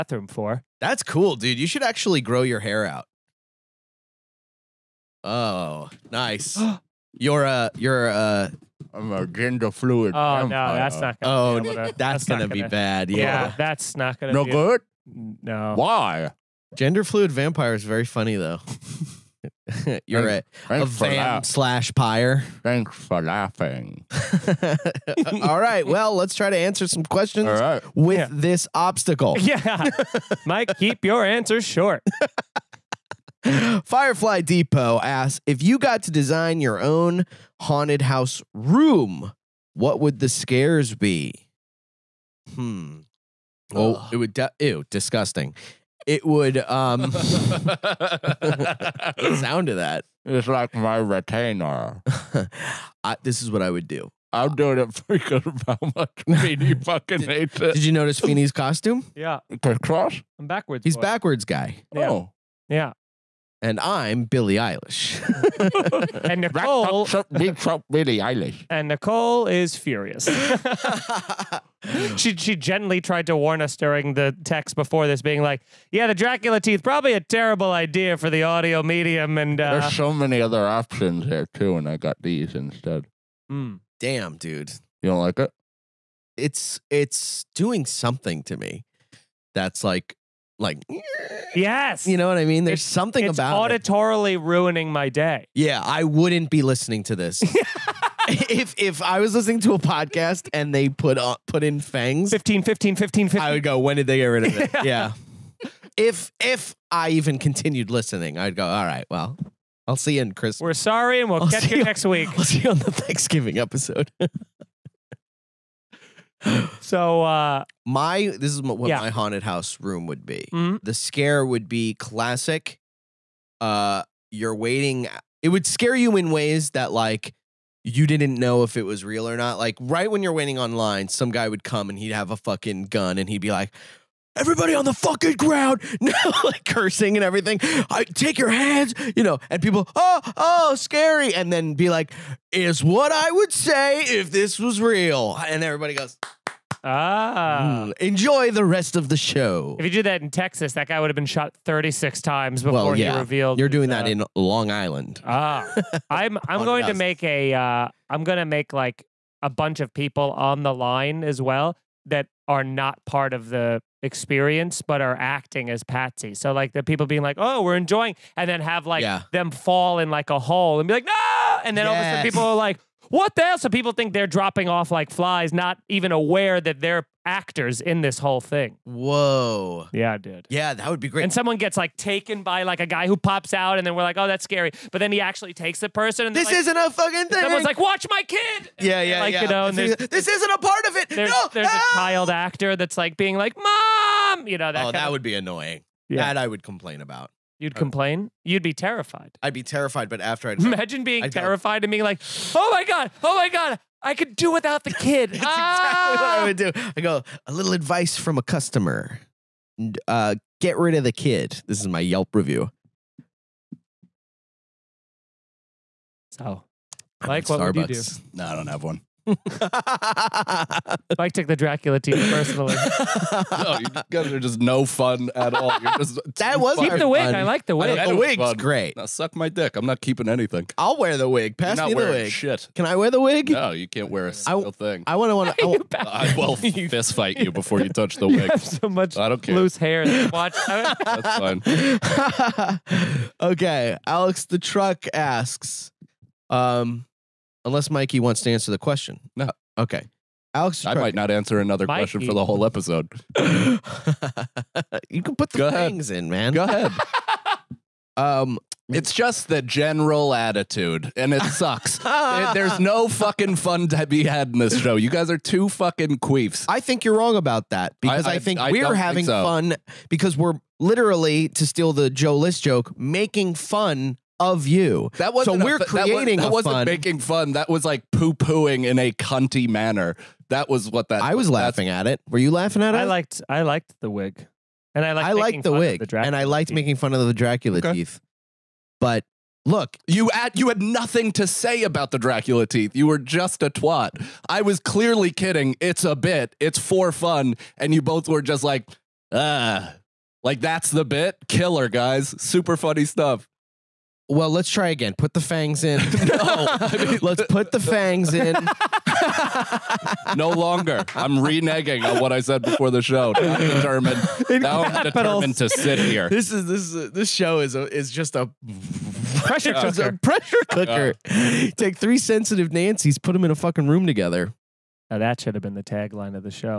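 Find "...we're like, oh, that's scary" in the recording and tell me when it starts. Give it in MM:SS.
03:03.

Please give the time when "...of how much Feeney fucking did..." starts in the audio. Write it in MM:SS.
00:55.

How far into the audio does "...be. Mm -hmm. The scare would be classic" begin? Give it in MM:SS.
02:00.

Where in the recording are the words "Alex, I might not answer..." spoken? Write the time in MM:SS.
04:10.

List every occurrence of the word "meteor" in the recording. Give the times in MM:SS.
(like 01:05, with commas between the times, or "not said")
not said.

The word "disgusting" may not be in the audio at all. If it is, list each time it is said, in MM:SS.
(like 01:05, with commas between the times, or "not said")
00:44.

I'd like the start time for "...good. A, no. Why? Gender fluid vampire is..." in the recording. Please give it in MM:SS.
00:14.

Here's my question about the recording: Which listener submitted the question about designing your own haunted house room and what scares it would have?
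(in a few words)
Firefly Depot.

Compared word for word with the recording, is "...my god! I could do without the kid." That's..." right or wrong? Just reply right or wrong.
right.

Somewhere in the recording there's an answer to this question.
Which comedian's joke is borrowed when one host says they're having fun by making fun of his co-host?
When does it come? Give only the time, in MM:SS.
04:32.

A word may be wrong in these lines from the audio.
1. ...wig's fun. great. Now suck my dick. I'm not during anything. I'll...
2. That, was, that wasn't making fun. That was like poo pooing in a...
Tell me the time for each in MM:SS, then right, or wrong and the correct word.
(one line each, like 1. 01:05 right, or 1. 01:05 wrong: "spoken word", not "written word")
1. 03:48 wrong: "keeping", not "during"
2. 04:36 right.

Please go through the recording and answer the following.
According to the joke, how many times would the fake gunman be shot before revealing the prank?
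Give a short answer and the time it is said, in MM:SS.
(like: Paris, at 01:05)
36, at 02:31.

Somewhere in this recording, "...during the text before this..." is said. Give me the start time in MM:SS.
01:13.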